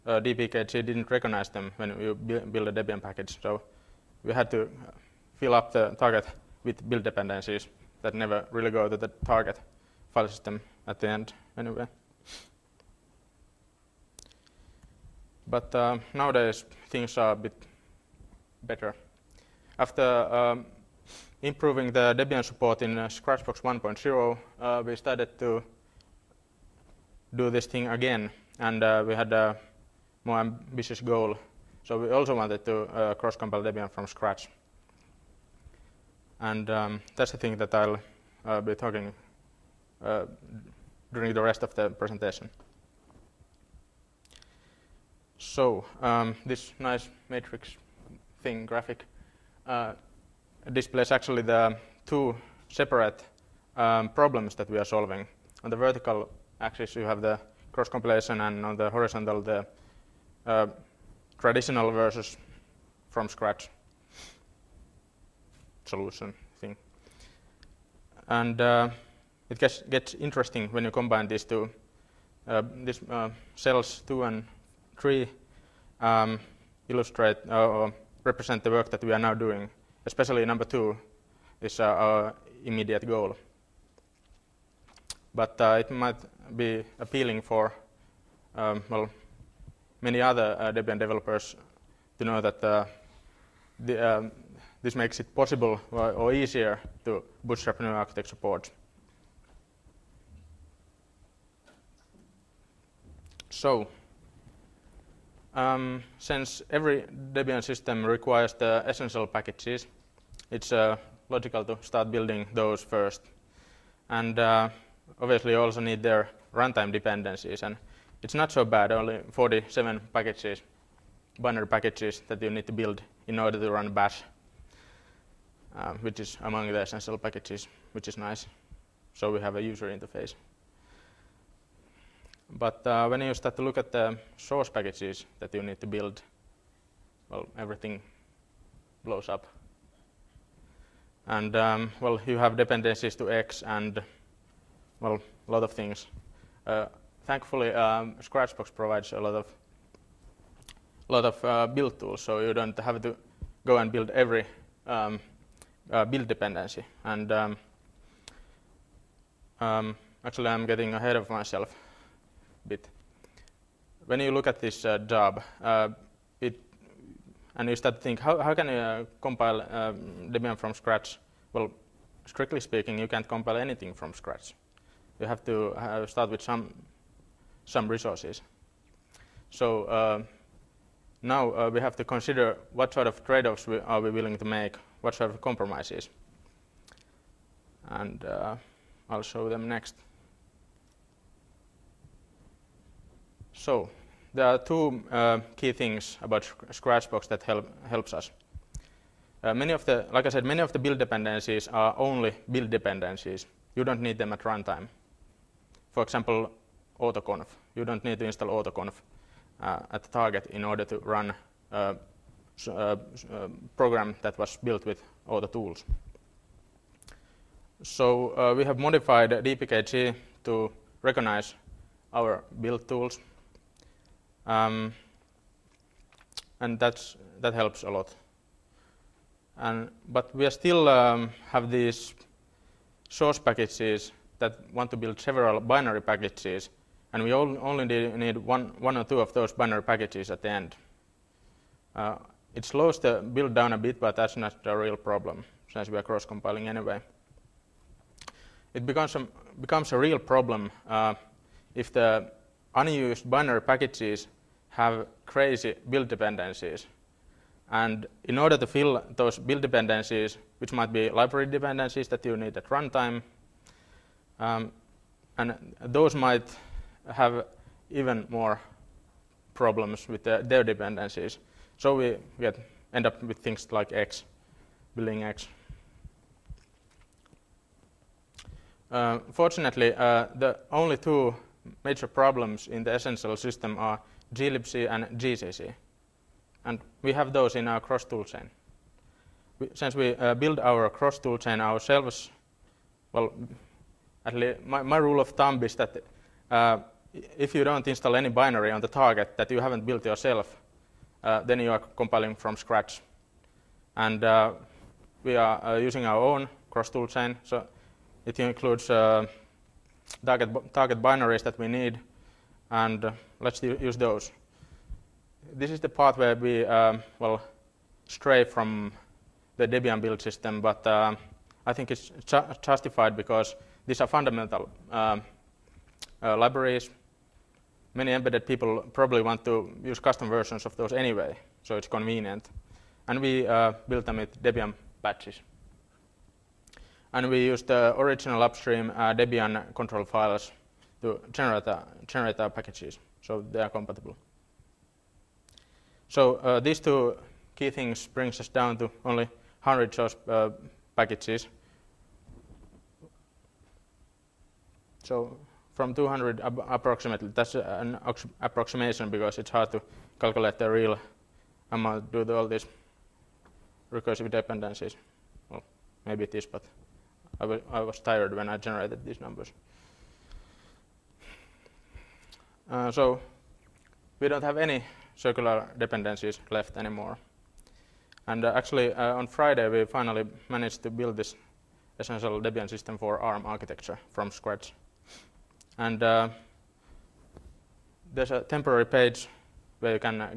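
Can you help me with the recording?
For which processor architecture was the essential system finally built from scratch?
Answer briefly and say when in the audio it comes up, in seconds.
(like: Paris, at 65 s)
ARM, at 383 s.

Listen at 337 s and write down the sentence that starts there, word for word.
And we used the original upstream uh, Debian control files to generate, uh, generate our packages, so they are compatible.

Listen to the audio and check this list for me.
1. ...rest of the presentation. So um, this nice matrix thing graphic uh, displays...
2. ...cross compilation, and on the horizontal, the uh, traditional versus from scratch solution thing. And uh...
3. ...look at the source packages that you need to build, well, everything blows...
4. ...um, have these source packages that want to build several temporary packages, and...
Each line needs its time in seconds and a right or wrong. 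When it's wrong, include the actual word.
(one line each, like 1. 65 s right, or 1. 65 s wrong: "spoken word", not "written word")
1. 41 s right
2. 57 s right
3. 133 s right
4. 230 s wrong: "binary", not "temporary".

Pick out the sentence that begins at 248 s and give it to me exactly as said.
It becomes a, becomes a real problem uh, if the unused binary packages have crazy build dependencies.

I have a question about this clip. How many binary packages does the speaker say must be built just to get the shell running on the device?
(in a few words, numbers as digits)
47.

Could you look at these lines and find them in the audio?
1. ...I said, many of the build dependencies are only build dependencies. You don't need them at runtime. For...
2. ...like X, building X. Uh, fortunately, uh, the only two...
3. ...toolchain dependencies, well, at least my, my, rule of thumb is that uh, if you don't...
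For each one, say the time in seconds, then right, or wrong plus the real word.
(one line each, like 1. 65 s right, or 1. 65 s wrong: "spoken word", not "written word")
1. 200 s right
2. 273 s right
3. 291 s wrong: "ourselves", not "dependencies".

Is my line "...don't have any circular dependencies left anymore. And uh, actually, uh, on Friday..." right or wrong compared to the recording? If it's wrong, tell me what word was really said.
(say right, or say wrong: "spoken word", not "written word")
right.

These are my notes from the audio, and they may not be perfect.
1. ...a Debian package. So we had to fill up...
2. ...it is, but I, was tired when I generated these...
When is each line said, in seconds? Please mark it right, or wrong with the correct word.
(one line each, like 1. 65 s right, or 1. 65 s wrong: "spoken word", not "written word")
1. 2 s right
2. 366 s right.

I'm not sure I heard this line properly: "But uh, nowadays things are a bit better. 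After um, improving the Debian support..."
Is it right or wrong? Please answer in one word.
right.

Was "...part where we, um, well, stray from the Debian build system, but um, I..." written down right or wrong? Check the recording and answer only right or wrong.
right.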